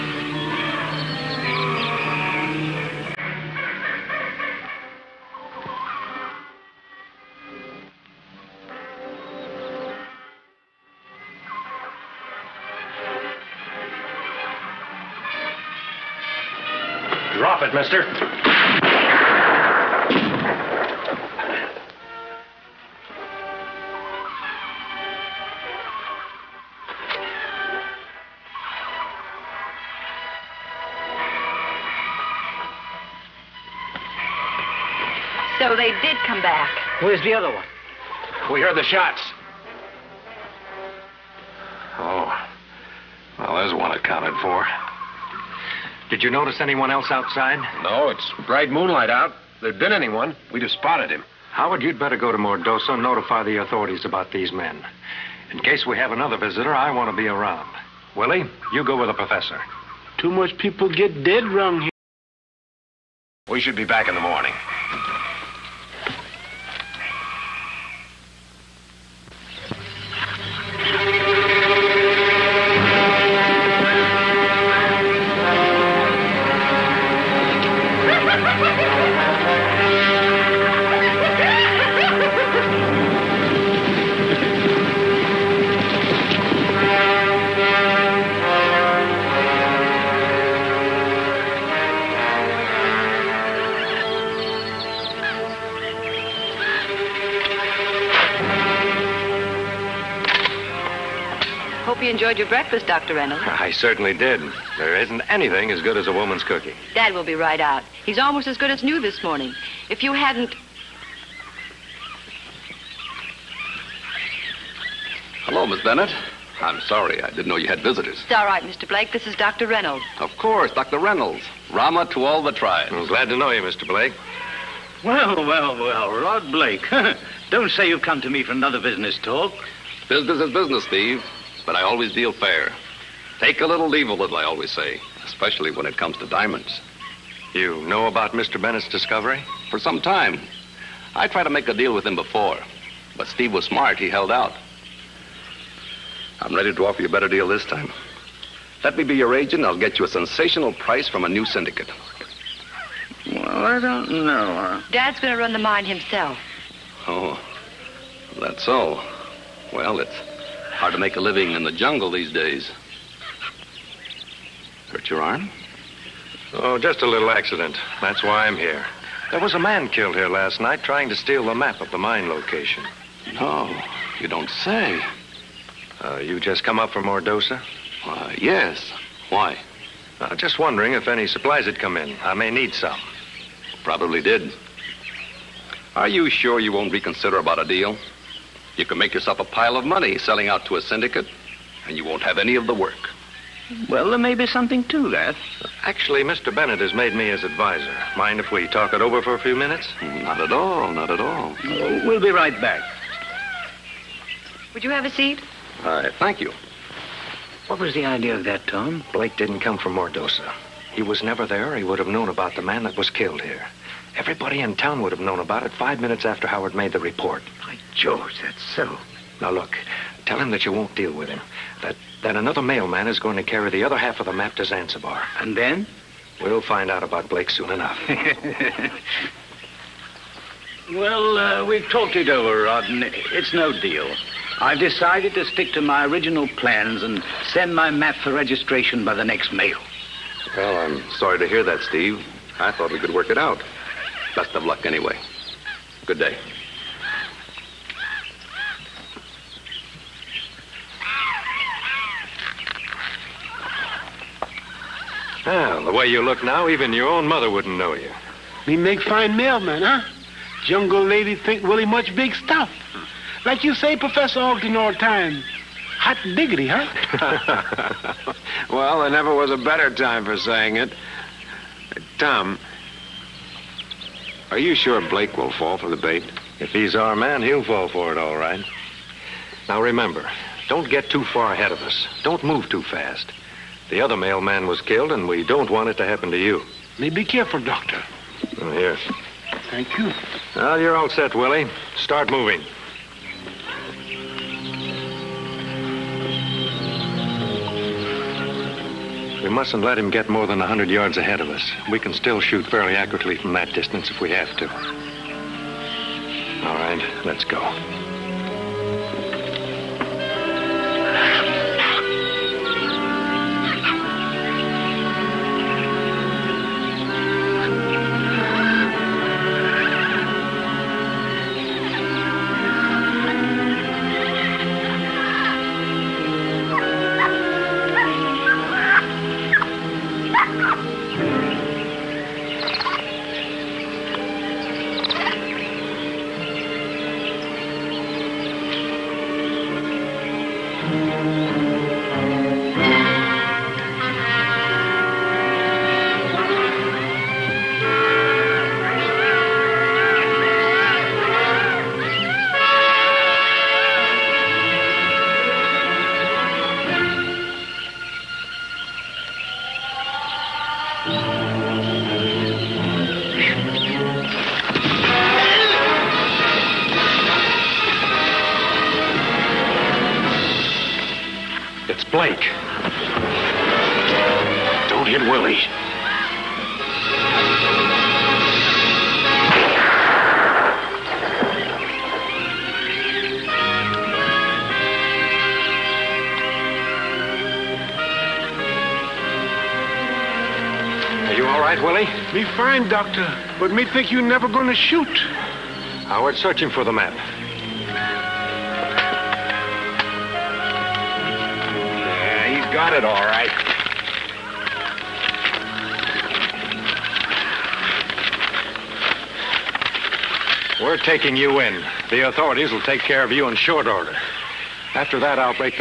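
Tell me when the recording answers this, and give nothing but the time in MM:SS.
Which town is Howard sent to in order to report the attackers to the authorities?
00:52.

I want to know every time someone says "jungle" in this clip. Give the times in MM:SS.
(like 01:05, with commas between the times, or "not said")
02:41, 04:20.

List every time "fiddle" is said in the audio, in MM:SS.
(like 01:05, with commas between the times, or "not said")
not said.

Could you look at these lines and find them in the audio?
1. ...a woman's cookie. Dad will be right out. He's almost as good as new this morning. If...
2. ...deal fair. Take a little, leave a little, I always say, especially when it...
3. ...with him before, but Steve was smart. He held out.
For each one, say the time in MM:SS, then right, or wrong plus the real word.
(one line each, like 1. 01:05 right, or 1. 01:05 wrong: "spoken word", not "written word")
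1. 01:46 right
2. 02:12 right
3. 02:21 right.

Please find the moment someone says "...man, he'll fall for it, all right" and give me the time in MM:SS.
04:37.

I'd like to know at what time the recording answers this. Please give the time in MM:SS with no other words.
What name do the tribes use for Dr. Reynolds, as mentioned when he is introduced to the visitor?
02:01.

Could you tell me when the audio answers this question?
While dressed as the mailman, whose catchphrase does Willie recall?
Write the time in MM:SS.
04:23.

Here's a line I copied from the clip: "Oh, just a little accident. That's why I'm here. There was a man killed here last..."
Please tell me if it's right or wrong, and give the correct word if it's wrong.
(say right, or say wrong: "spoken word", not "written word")
right.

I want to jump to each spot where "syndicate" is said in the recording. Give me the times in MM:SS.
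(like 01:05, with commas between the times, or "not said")
02:31, 03:10.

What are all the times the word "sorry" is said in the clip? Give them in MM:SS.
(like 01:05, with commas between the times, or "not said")
01:56, 04:01.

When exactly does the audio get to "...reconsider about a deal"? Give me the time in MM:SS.
03:06.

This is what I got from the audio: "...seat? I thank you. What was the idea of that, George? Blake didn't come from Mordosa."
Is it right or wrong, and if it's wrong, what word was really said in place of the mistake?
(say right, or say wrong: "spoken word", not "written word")
wrong: "Tom", not "George".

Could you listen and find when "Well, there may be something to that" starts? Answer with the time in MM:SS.
03:13.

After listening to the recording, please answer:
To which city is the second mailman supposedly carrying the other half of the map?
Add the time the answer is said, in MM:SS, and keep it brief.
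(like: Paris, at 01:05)
Zanzibar, at 03:44.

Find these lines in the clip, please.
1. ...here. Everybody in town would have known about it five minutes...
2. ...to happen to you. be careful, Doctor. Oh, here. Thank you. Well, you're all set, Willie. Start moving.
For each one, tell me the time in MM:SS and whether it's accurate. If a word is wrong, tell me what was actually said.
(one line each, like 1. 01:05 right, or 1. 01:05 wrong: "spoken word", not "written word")
1. 03:33 right
2. 04:45 right.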